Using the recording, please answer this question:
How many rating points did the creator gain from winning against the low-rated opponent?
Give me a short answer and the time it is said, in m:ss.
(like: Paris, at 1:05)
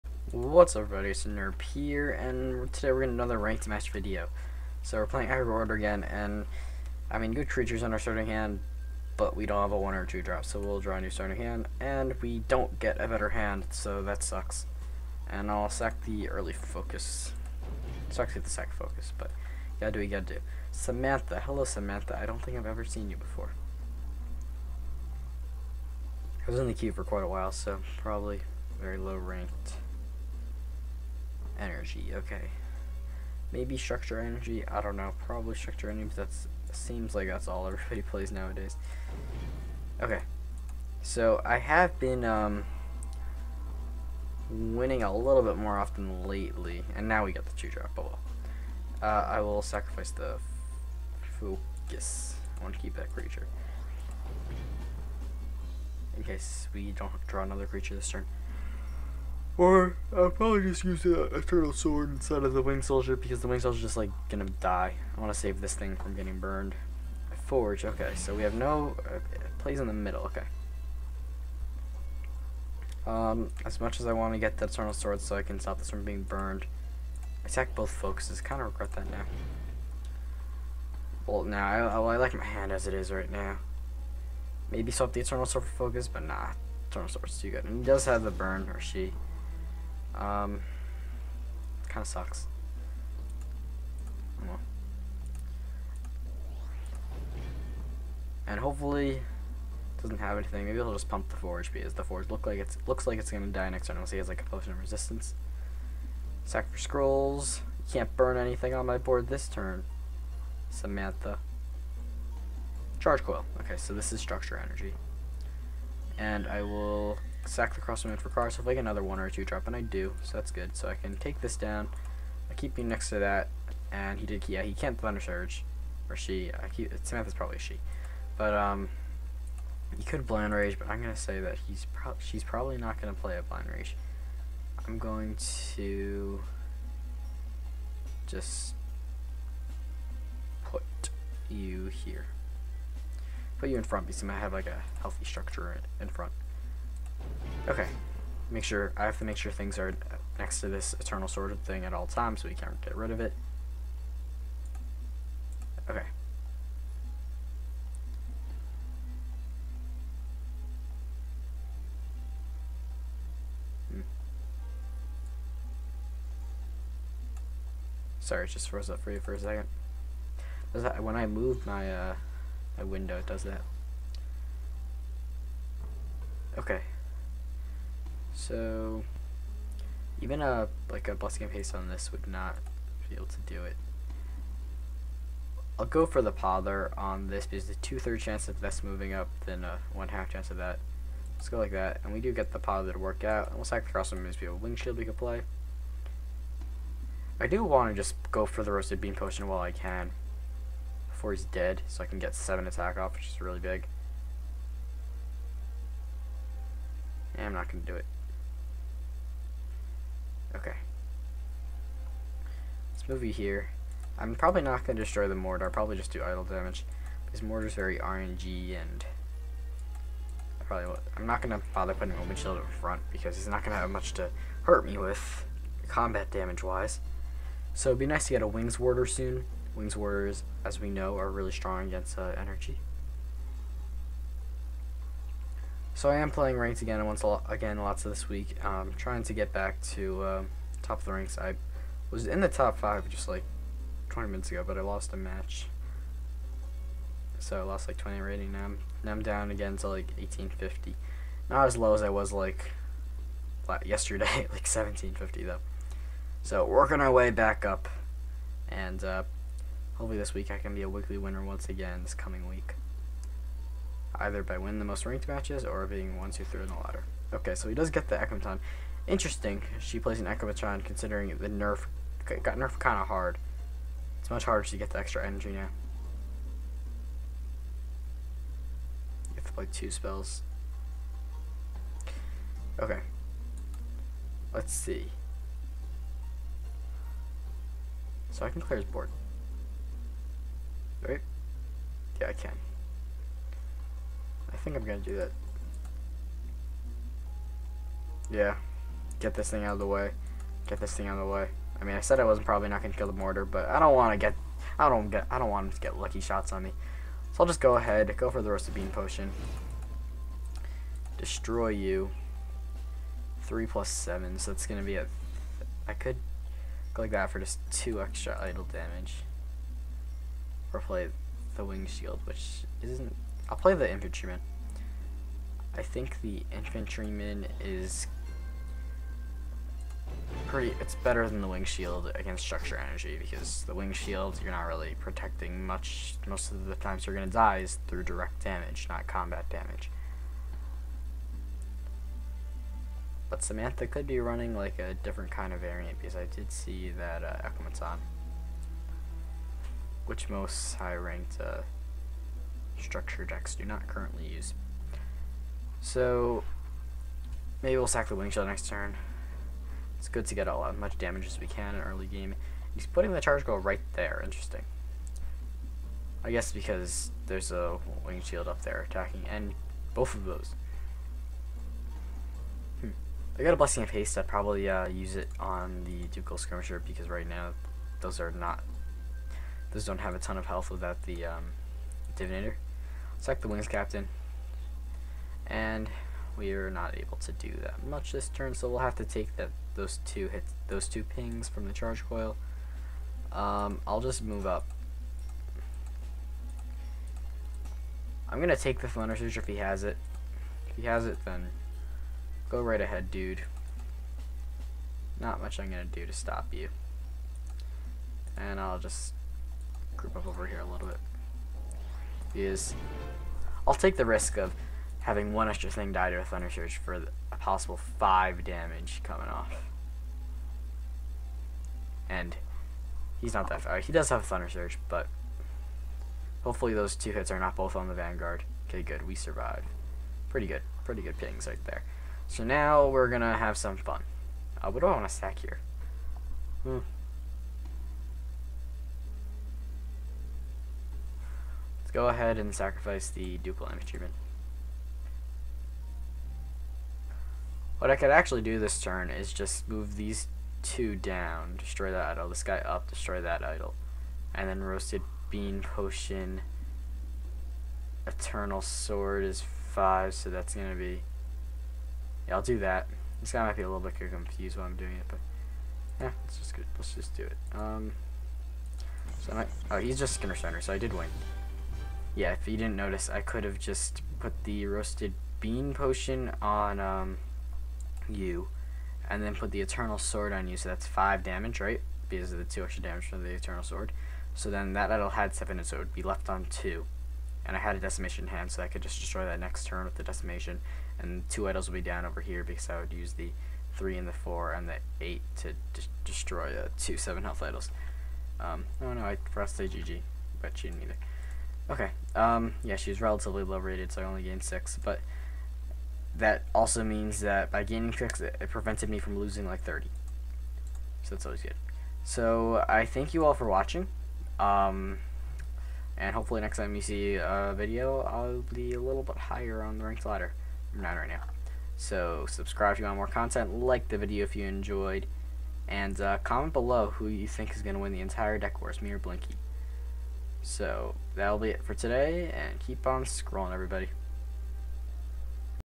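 6, at 8:24.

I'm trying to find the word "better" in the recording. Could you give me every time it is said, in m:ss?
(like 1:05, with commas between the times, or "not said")
0:13, 5:30.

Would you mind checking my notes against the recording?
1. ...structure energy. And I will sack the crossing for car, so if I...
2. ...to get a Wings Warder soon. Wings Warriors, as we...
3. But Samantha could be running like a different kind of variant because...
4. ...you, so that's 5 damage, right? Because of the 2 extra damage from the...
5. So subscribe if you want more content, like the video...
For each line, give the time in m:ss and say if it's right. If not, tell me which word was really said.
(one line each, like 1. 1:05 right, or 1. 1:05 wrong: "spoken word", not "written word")
1. 1:54 right
2. 3:48 right
3. 5:43 right
4. 8:00 right
5. 8:41 right.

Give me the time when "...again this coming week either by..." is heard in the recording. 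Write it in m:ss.
4:21.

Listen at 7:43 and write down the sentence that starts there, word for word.
This guy might be a little bit confused while I'm doing it, but yeah, let's just let's just do it.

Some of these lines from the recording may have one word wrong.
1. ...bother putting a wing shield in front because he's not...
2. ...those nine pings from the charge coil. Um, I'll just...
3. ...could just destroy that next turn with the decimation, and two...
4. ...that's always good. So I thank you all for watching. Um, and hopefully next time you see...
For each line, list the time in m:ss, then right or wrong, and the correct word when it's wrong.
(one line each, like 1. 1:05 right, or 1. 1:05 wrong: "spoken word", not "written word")
1. 3:41 right
2. 6:30 wrong: "two", not "nine"
3. 8:08 right
4. 8:31 right.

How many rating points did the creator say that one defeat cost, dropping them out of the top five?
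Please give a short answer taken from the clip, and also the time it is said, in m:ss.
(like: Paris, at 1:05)
20, at 4:07.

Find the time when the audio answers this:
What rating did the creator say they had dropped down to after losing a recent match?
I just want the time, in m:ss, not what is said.
4:10.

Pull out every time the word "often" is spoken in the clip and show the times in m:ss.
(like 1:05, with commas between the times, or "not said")
0:45.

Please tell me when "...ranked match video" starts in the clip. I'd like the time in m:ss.
0:03.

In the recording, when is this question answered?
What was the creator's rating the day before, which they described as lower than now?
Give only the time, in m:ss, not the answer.
4:14.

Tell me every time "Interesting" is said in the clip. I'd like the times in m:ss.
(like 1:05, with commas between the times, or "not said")
4:29, 6:04.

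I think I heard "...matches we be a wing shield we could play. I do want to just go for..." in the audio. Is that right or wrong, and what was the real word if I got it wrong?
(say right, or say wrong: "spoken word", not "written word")
wrong: "moves", not "matches".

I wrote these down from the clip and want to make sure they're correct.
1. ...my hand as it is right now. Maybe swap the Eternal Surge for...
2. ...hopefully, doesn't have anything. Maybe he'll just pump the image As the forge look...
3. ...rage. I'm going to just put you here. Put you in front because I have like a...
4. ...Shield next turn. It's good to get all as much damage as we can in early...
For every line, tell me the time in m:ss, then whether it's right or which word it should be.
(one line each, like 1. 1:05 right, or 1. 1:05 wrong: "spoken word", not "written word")
1. 1:22 wrong: "Sword", not "Surge"
2. 1:38 wrong: "forge", not "image"
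3. 2:13 right
4. 5:58 right.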